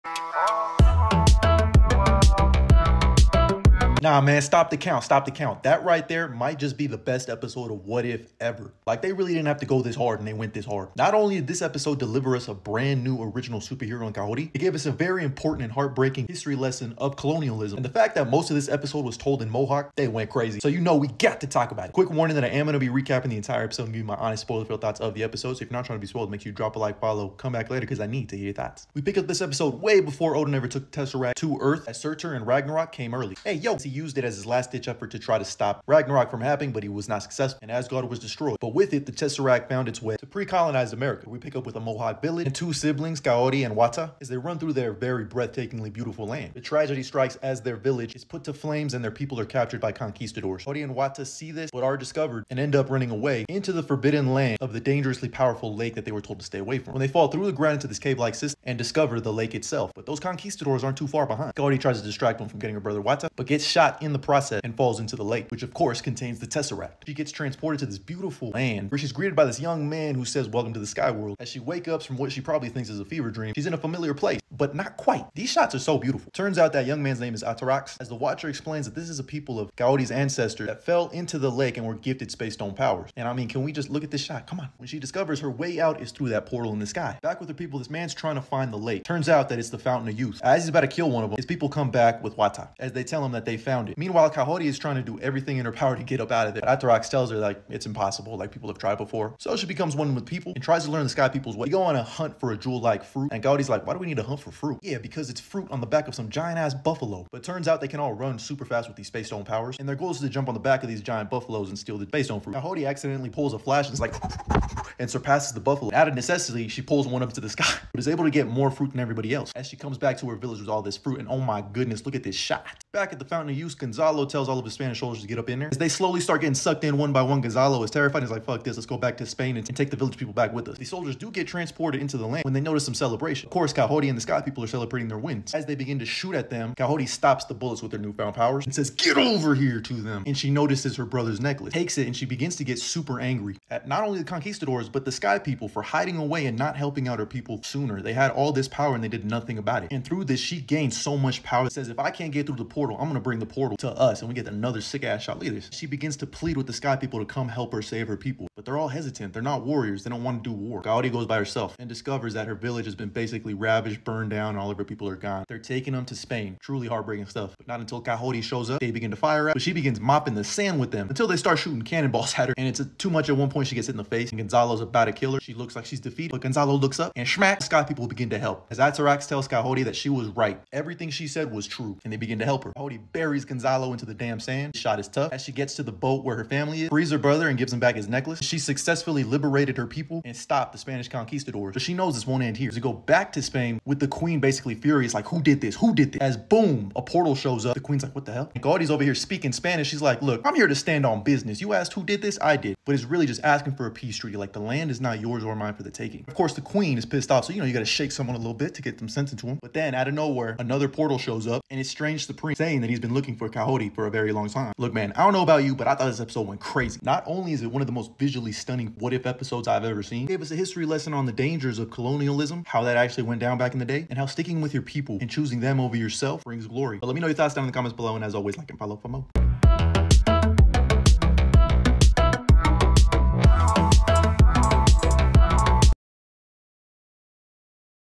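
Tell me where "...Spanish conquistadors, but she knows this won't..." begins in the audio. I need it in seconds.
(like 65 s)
190 s.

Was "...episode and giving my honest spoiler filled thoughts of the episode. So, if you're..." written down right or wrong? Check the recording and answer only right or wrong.
right.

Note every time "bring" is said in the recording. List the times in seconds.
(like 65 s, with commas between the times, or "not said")
153 s, 226 s.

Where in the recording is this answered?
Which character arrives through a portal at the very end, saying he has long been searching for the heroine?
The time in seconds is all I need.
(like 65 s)
211 s.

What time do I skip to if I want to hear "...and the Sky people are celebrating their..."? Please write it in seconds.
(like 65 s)
134 s.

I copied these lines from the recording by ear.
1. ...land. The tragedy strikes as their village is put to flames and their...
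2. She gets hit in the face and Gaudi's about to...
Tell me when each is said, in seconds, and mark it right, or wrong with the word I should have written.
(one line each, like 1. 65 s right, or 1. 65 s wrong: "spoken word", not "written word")
1. 46 s right
2. 173 s wrong: "Gonzalo", not "Gaudi".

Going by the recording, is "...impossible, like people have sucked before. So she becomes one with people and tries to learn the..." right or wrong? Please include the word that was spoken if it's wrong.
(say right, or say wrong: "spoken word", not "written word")
wrong: "tried", not "sucked".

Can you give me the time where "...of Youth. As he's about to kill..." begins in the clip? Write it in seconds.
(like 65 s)
90 s.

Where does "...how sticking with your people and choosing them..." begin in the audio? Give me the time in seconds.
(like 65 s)
224 s.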